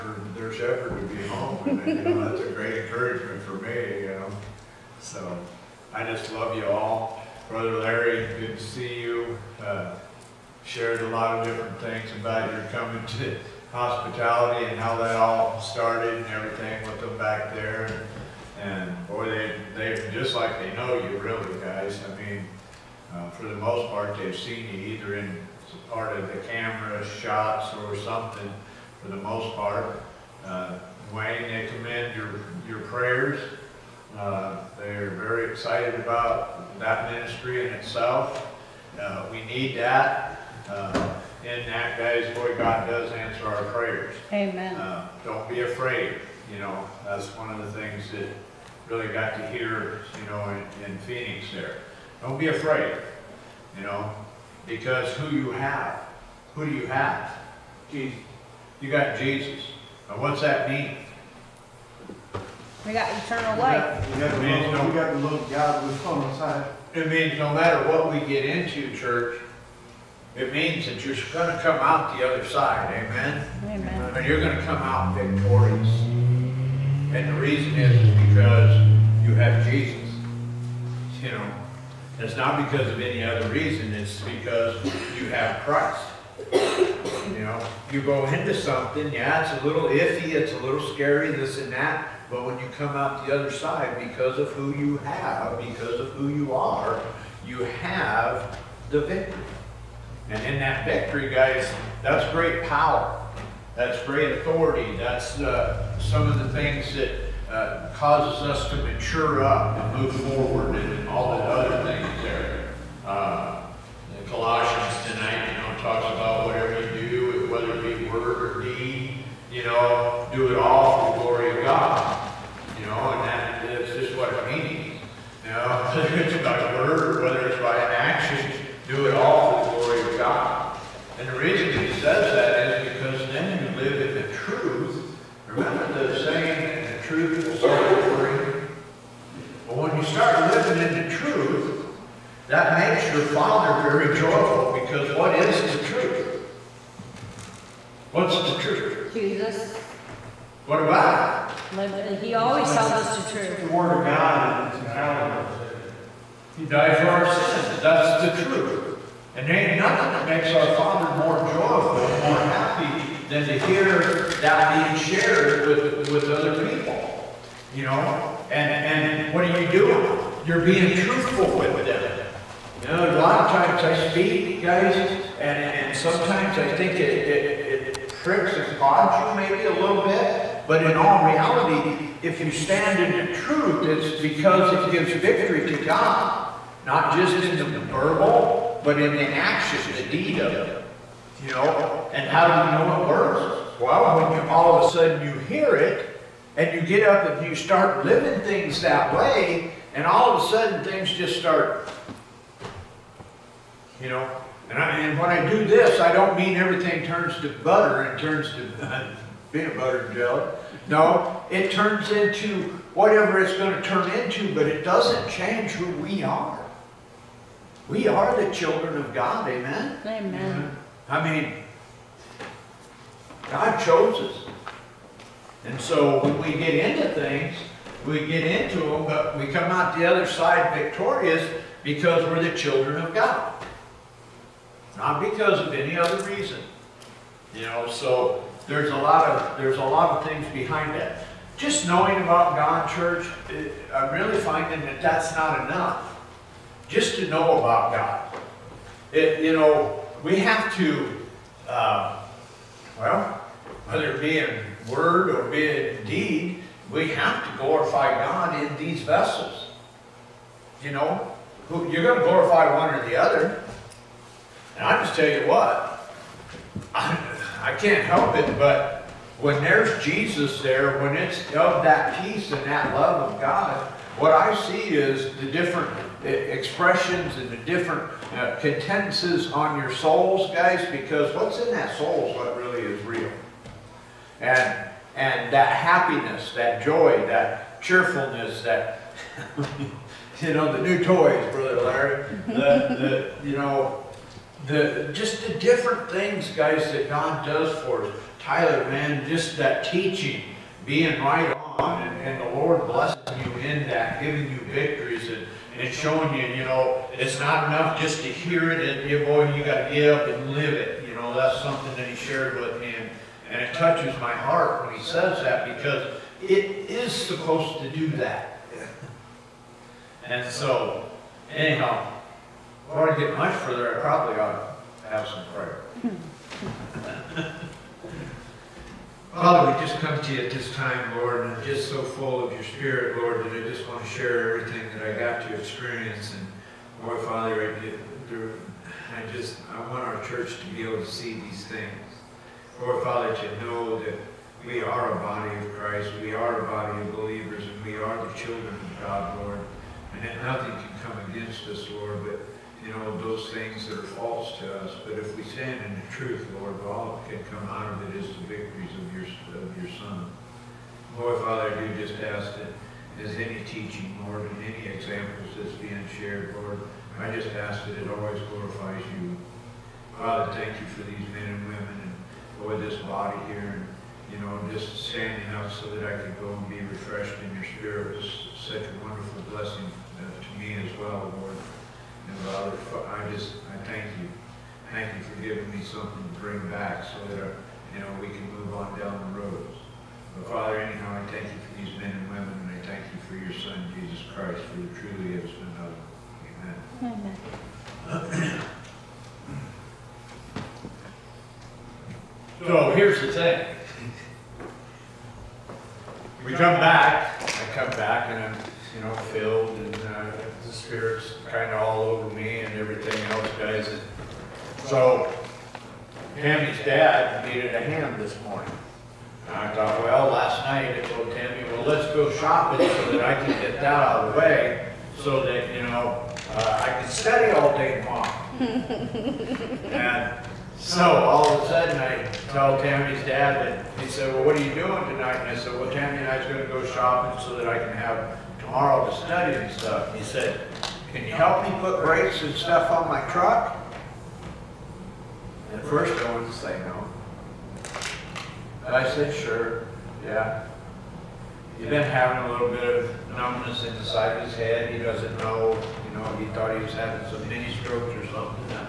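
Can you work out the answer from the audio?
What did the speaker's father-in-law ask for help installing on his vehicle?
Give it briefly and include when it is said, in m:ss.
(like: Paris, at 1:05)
Brakes, at 7:22.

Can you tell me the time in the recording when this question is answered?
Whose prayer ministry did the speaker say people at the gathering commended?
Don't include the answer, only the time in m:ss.
0:31.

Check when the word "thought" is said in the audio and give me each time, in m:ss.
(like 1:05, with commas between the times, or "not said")
6:59, 7:36.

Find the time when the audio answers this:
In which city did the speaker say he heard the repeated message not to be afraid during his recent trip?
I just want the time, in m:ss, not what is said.
0:50.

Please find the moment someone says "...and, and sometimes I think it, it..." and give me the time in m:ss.
2:55.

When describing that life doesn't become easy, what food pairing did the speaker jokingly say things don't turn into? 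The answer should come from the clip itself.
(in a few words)
Peanut butter and jelly.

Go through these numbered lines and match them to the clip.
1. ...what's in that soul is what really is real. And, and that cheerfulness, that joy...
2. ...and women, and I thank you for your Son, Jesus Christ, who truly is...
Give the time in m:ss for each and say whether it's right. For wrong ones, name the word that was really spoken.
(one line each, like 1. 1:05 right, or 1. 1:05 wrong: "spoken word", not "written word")
1. 4:41 wrong: "happiness", not "cheerfulness"
2. 6:32 right.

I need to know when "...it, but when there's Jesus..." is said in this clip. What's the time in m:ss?
4:28.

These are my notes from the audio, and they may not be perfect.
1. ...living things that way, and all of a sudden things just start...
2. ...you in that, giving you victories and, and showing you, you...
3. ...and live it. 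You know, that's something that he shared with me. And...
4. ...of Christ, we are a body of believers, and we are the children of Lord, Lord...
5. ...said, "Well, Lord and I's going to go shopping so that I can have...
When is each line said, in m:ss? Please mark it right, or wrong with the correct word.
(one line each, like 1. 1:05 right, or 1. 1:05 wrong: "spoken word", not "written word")
1. 3:18 right
2. 5:03 right
3. 5:10 right
4. 5:45 wrong: "God", not "Lord"
5. 7:15 wrong: "Tammy", not "Lord".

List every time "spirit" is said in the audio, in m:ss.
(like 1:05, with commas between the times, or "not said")
5:32, 6:17, 6:50.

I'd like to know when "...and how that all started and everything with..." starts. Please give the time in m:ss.
0:14.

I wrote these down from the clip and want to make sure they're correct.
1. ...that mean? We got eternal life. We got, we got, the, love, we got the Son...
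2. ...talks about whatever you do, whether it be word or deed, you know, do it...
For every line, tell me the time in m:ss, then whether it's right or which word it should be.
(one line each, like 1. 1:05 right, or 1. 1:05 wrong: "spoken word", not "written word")
1. 1:00 wrong: "God", not "Son"
2. 1:55 right.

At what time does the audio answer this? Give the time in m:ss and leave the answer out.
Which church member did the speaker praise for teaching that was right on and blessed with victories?
4:58.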